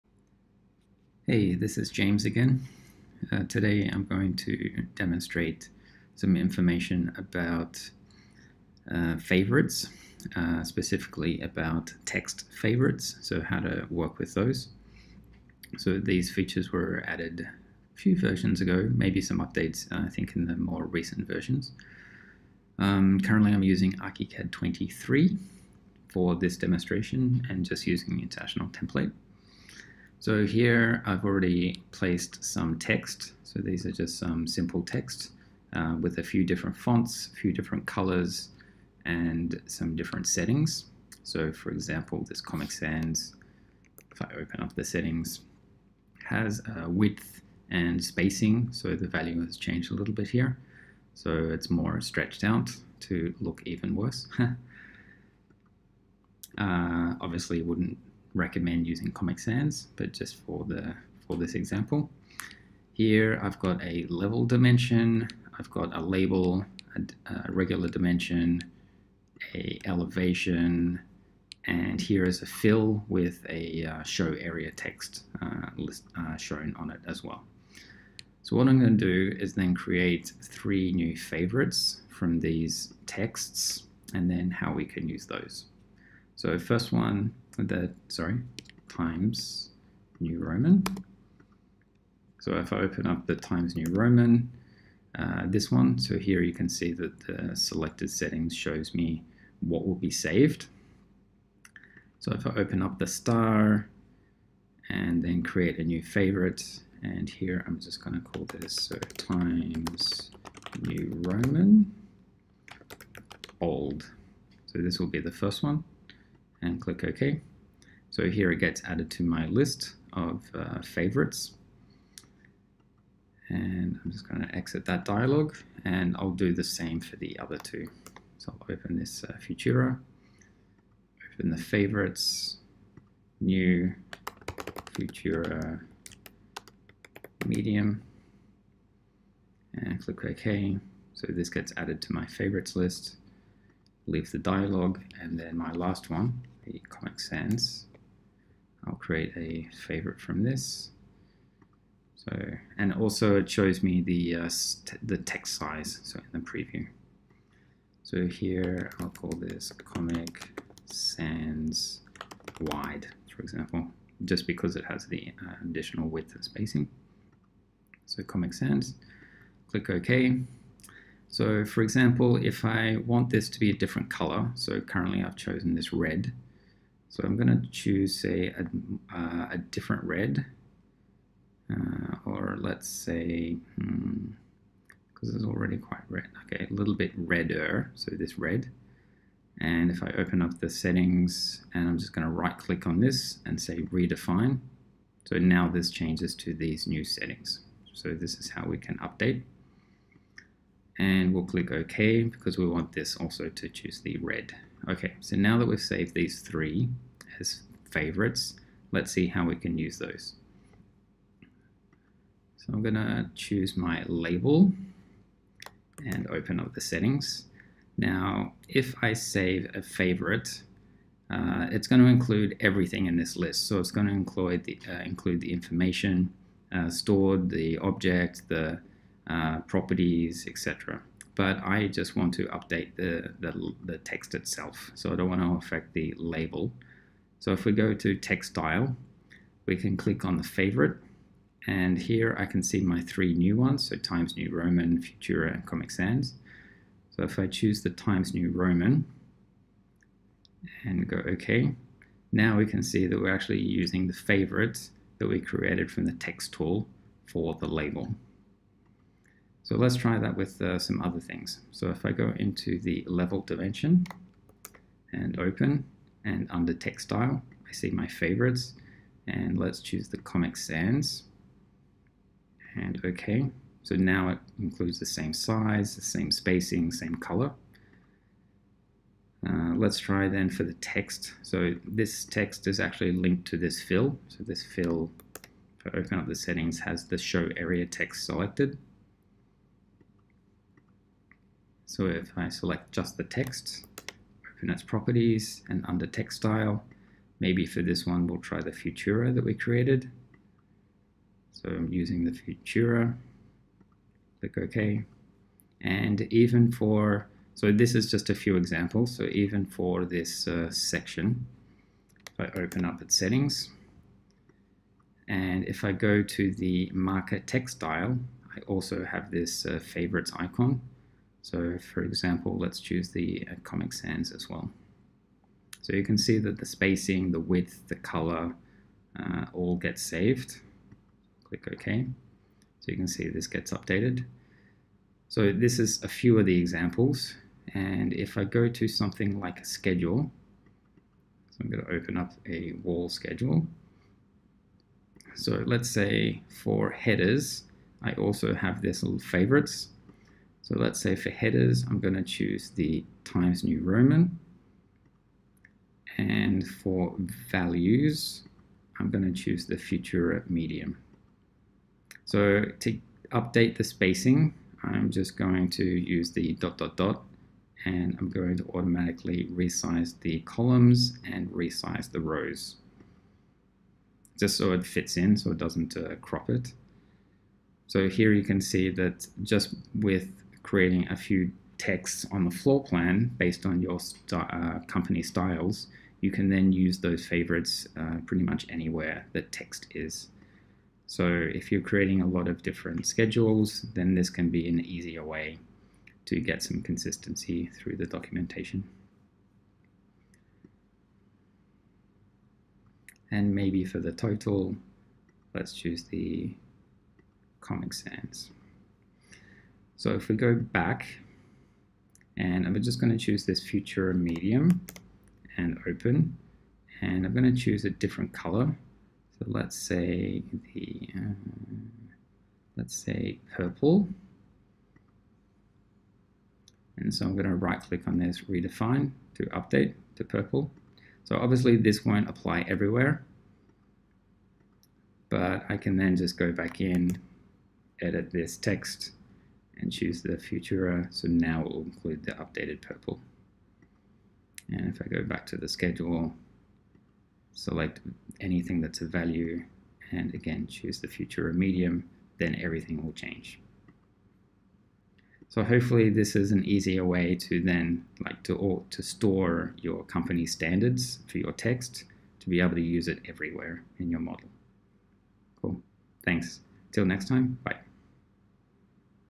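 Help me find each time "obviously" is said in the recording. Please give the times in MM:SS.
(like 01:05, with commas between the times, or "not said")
00:57, 07:11.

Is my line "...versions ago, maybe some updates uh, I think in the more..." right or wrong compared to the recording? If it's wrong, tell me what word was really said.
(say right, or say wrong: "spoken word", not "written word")
right.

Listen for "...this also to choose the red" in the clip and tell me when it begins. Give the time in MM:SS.
03:22.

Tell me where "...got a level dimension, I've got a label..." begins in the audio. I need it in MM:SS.
01:03.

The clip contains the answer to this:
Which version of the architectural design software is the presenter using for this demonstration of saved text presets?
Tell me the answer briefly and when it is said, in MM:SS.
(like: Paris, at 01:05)
ArchiCAD 23, at 00:23.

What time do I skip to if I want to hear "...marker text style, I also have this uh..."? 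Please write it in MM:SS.
05:16.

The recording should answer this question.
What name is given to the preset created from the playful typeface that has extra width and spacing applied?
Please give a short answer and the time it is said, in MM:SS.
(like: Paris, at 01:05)
Comic Sans Wide, at 02:39.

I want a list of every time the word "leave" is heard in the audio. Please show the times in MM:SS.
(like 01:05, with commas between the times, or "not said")
02:24.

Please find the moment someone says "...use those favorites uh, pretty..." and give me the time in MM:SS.
06:26.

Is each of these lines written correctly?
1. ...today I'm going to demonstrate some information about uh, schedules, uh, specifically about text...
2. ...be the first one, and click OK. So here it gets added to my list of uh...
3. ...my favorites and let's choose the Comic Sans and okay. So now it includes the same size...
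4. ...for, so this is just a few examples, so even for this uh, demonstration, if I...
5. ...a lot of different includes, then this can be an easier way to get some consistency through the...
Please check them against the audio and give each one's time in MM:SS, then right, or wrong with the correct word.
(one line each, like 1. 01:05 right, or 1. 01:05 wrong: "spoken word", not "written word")
1. 00:03 wrong: "favorites", not "schedules"
2. 01:55 right
3. 04:27 right
4. 05:06 wrong: "section", not "demonstration"
5. 06:32 wrong: "schedules", not "includes".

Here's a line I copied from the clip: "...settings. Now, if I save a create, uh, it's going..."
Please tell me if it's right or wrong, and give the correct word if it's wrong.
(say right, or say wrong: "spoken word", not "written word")
wrong: "favorite", not "create".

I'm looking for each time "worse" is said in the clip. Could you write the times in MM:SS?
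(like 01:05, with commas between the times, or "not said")
00:53.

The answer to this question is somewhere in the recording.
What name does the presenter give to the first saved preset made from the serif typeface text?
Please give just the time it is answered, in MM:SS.
01:49.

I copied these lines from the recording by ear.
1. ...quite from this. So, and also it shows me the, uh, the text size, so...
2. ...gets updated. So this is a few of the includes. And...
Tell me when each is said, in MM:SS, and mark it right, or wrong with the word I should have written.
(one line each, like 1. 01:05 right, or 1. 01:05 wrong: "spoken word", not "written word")
1. 02:29 wrong: "favorite", not "quite"
2. 05:33 wrong: "examples", not "includes".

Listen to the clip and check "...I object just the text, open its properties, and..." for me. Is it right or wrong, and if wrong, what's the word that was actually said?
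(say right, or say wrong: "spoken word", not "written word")
wrong: "select", not "object".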